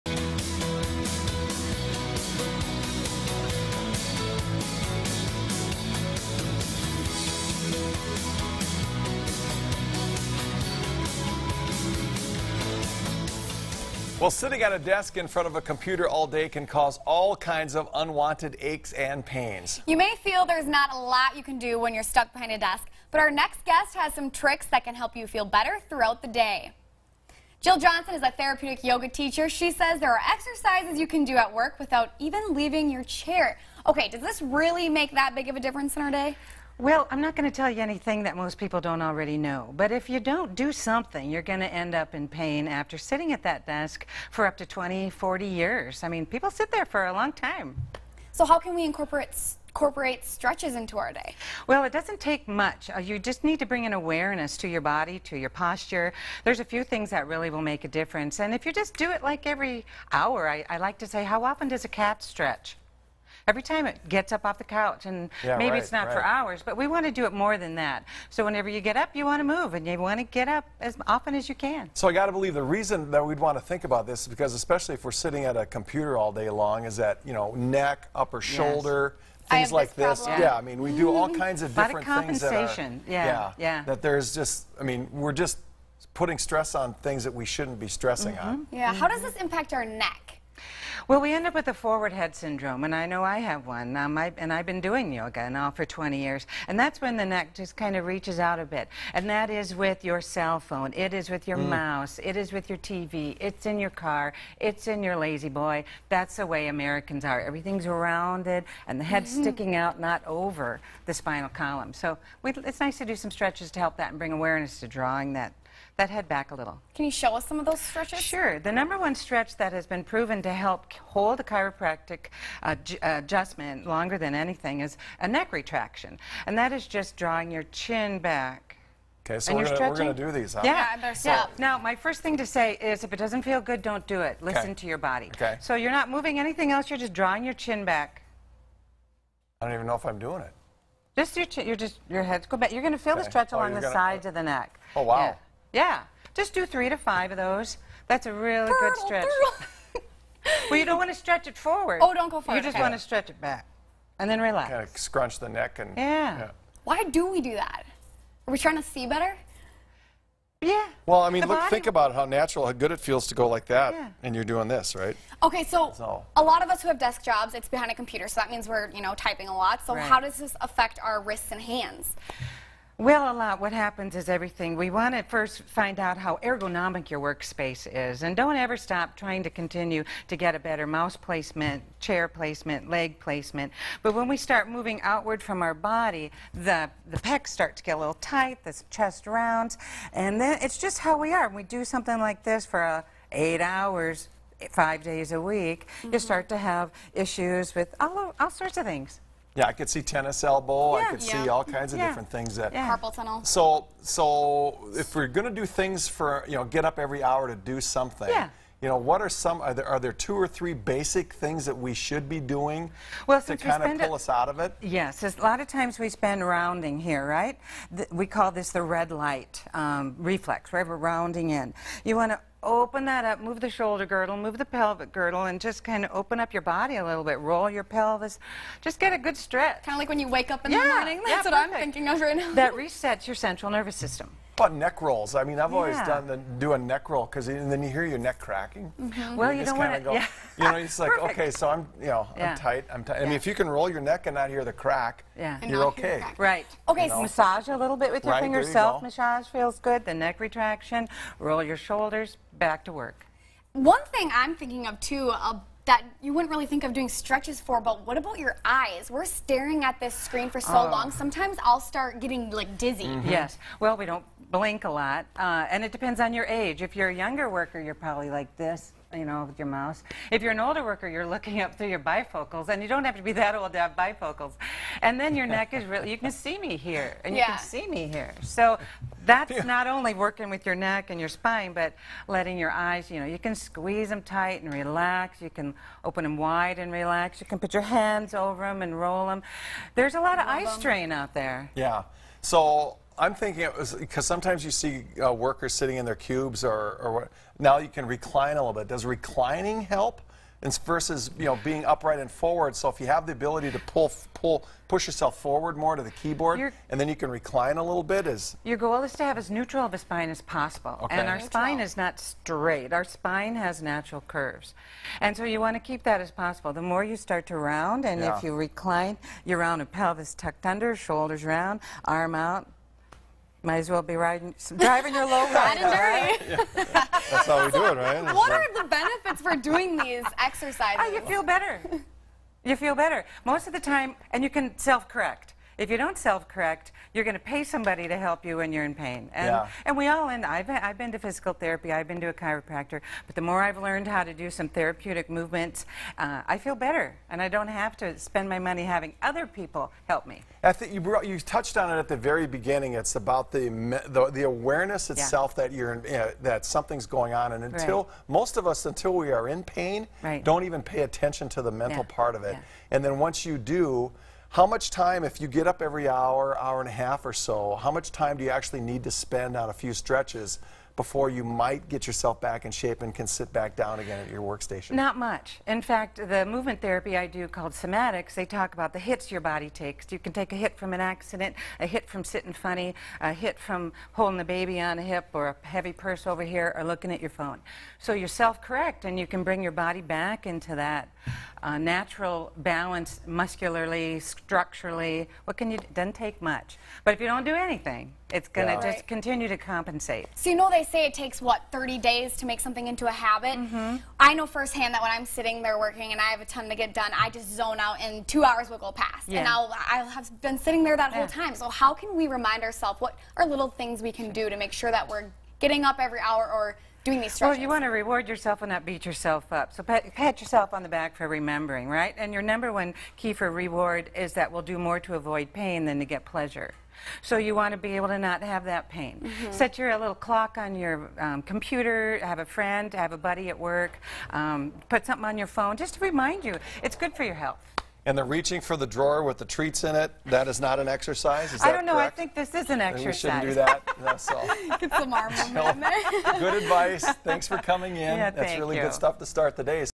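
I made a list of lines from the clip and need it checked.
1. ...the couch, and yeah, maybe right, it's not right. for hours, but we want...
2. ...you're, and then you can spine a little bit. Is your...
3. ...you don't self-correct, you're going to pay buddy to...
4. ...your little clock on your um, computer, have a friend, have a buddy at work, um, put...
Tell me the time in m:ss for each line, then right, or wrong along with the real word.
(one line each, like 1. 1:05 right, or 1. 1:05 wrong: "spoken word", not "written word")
1. 1:04 right
2. 5:06 wrong: "recline", not "spine"
3. 5:35 wrong: "somebody", not "buddy"
4. 7:09 right.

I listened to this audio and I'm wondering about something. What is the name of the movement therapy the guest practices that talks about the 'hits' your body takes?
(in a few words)
somatics.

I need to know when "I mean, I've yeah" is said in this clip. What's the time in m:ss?
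3:55.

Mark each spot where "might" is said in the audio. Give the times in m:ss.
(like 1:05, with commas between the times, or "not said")
5:23, 6:11.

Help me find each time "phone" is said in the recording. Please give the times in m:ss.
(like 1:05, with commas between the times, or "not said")
1:40, 6:27, 7:15.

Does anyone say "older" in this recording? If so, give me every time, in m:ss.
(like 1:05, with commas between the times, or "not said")
4:30.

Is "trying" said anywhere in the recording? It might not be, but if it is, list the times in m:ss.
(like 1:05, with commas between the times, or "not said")
2:38, 2:59.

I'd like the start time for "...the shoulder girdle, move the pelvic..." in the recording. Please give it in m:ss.
3:43.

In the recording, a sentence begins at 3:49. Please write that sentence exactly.
Kind of like when you wake up in yeah, the morning.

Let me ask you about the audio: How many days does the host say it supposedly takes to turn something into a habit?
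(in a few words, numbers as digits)
30.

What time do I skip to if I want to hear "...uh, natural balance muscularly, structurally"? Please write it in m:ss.
6:31.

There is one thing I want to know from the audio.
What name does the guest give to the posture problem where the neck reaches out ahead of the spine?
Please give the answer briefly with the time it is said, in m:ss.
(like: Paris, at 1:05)
forward head syndrome, at 1:31.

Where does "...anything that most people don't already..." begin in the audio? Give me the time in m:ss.
0:37.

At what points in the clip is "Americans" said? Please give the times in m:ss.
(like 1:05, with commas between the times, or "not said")
1:46.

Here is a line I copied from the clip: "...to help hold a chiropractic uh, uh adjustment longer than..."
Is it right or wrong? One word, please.
right.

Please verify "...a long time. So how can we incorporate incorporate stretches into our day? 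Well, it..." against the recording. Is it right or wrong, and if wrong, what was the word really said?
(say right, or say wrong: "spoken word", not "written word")
right.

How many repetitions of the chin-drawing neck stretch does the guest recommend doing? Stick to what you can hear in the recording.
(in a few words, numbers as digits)
3 to 5.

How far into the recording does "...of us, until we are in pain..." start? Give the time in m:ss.
5:58.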